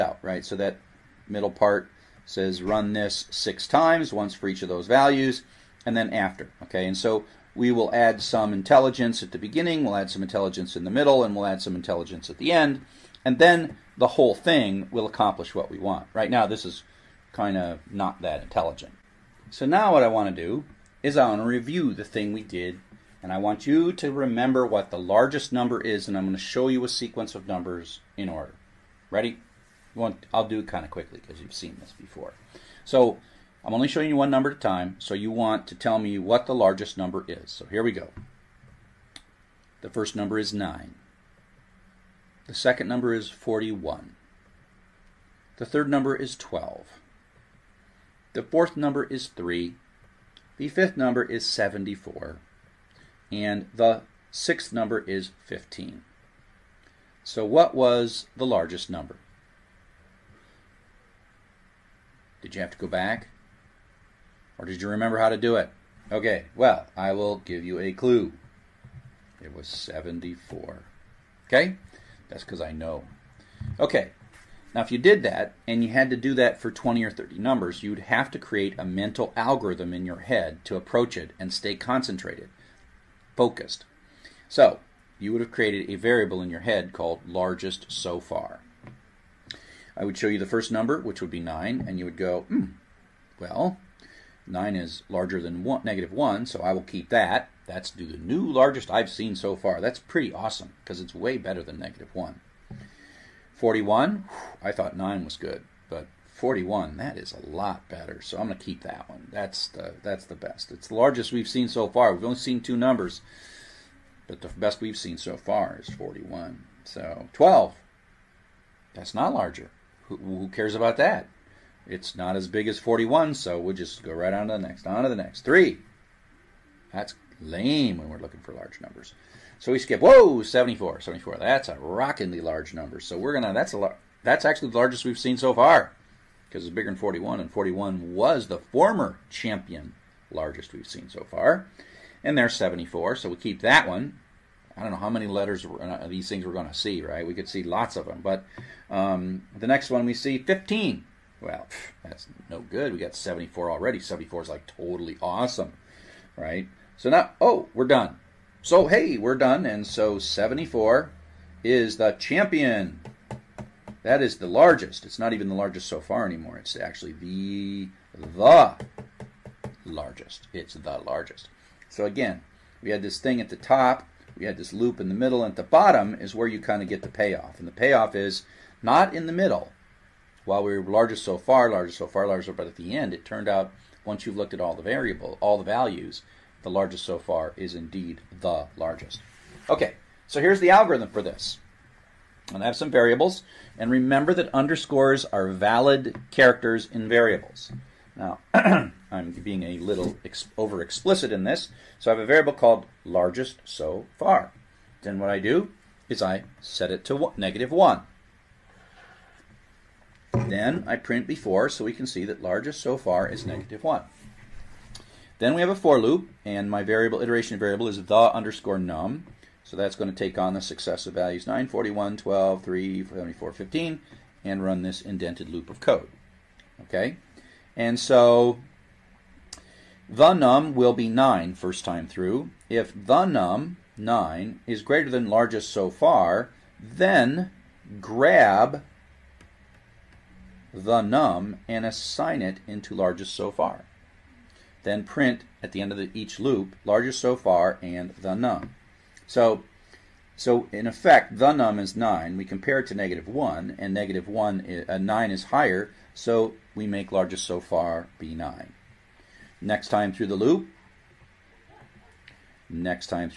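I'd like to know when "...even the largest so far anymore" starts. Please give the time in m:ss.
2:45.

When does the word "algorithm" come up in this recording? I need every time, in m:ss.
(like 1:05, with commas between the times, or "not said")
1:19, 3:10.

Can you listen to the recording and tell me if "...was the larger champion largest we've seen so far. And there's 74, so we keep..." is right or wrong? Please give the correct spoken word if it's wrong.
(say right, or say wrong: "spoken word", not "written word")
wrong: "former", not "larger".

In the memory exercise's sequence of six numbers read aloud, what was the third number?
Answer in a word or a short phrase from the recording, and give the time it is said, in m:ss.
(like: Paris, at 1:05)
12, at 0:45.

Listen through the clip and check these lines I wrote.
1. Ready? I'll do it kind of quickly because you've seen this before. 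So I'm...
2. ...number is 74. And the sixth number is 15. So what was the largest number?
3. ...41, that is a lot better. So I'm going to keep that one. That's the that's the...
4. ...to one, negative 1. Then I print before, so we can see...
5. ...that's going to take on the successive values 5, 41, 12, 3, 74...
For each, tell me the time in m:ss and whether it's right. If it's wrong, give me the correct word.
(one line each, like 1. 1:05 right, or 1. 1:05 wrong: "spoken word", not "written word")
1. 0:29 right
2. 0:50 right
3. 1:46 right
4. 3:27 right
5. 3:39 wrong: "9", not "5".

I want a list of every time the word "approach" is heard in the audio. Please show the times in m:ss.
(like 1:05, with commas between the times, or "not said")
1:20.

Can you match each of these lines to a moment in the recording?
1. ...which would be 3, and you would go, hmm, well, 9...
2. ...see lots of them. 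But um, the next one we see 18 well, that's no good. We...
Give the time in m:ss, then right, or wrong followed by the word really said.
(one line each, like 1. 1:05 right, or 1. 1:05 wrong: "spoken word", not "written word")
1. 1:30 wrong: "9", not "3"
2. 2:27 wrong: "15", not "18".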